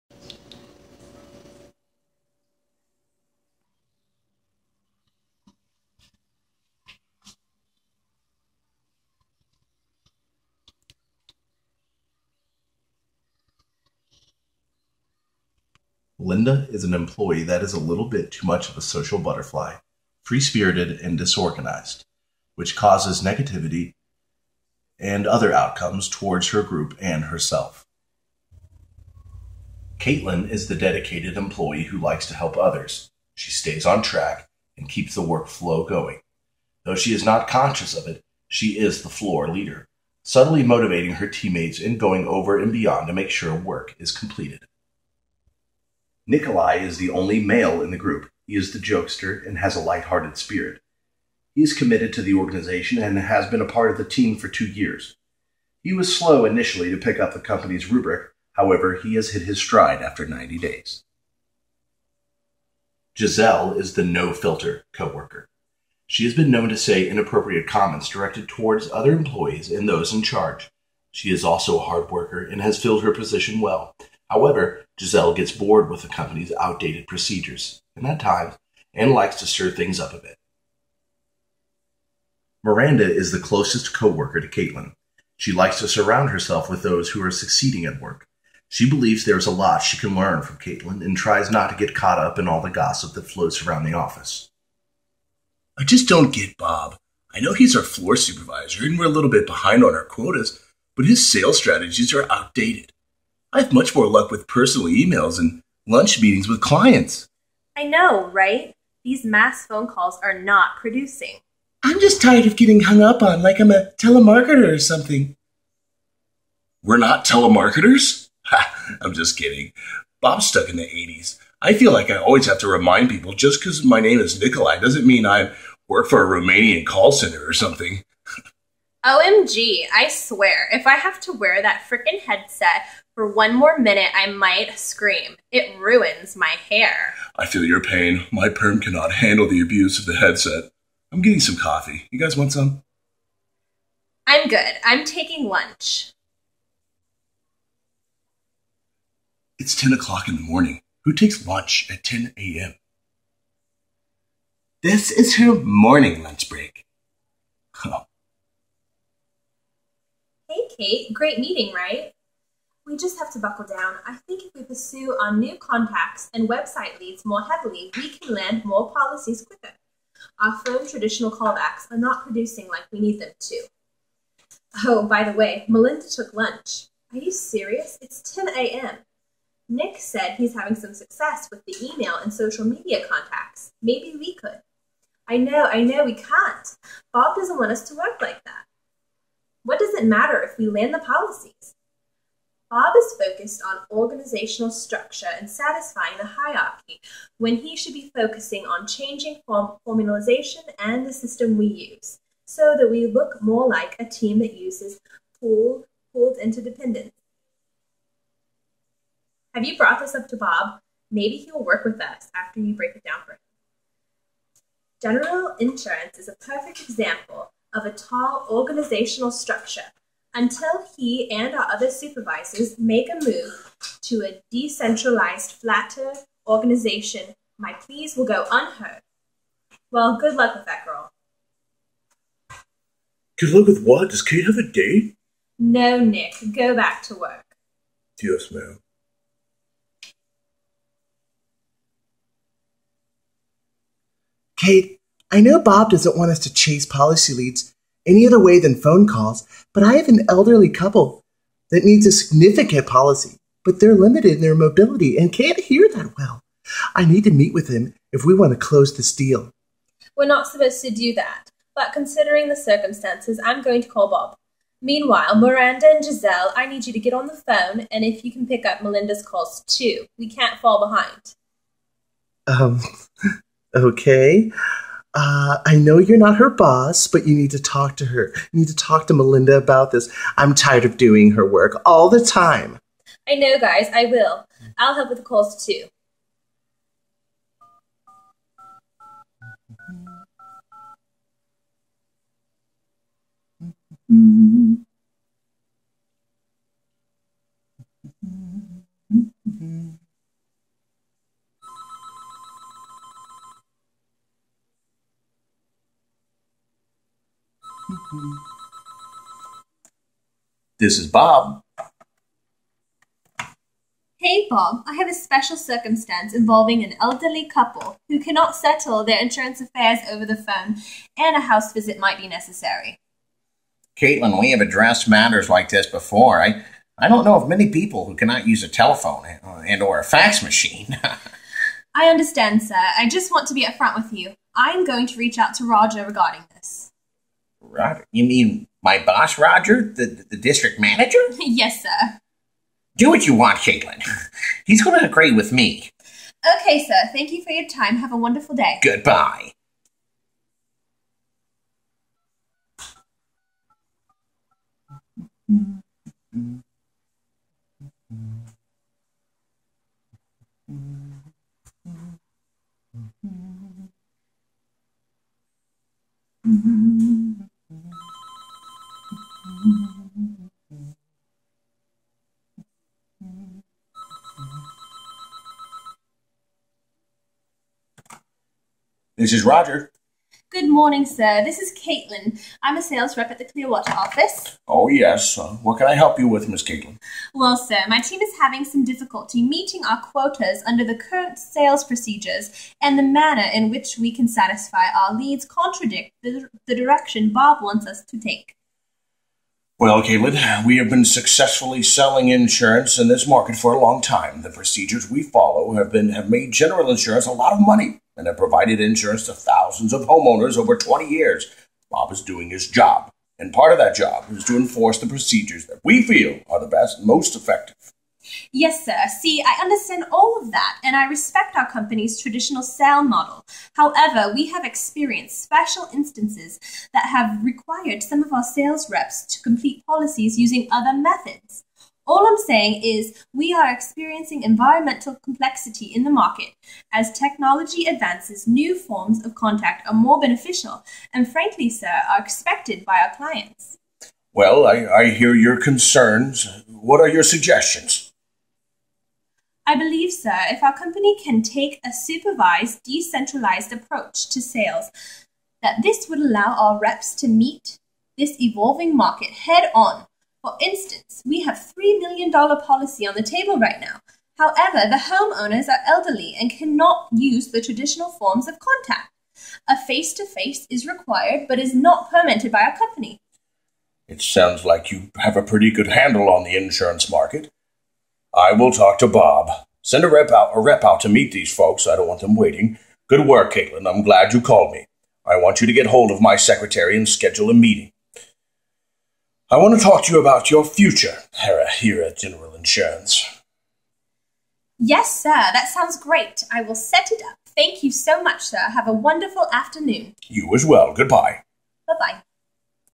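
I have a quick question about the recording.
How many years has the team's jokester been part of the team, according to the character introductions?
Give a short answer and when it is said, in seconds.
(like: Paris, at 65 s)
2, at 54 s.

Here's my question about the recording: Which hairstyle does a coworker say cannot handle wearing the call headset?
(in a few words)
perm.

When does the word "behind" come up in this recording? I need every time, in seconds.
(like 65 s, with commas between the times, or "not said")
99 s, 270 s.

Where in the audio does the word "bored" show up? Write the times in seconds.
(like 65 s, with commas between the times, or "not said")
75 s.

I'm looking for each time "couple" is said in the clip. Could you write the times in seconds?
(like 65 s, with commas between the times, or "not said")
250 s, 317 s.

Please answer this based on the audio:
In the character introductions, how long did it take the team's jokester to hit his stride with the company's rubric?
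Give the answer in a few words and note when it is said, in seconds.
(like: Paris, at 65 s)
90 days, at 60 s.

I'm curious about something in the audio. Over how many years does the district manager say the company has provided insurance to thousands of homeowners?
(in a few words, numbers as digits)
20 years.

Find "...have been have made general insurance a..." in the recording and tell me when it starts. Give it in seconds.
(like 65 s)
405 s.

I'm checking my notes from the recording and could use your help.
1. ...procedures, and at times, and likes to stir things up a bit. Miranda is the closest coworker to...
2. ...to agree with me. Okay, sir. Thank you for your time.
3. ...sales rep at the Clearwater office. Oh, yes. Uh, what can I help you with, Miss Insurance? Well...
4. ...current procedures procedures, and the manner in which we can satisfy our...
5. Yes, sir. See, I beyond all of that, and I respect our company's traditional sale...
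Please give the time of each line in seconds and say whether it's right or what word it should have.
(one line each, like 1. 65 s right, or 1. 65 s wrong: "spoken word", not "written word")
1. 77 s right
2. 344 s right
3. 382 s wrong: "Caitlin", not "Insurance"
4. 390 s wrong: "sales", not "procedures"
5. 418 s wrong: "understand", not "beyond".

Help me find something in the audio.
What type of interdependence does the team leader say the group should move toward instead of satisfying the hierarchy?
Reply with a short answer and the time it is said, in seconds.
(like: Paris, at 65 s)
pooled interdependence, at 206 s.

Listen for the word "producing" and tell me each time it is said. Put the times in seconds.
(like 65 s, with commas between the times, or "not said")
110 s, 172 s.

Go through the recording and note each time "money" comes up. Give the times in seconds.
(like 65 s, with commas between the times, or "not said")
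407 s.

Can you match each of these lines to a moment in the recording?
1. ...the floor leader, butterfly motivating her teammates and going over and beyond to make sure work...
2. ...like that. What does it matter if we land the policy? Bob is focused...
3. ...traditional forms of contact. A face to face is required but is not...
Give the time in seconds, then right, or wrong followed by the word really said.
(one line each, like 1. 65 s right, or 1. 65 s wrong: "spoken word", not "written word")
1. 39 s wrong: "subtly", not "butterfly"
2. 188 s right
3. 467 s right.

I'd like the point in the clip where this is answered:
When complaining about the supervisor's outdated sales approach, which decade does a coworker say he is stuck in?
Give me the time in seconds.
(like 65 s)
120 s.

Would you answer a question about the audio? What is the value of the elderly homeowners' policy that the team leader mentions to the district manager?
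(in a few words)
$3 million.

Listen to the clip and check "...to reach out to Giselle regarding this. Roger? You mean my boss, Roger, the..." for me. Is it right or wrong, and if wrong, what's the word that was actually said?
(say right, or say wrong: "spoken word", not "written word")
wrong: "Roger", not "Giselle".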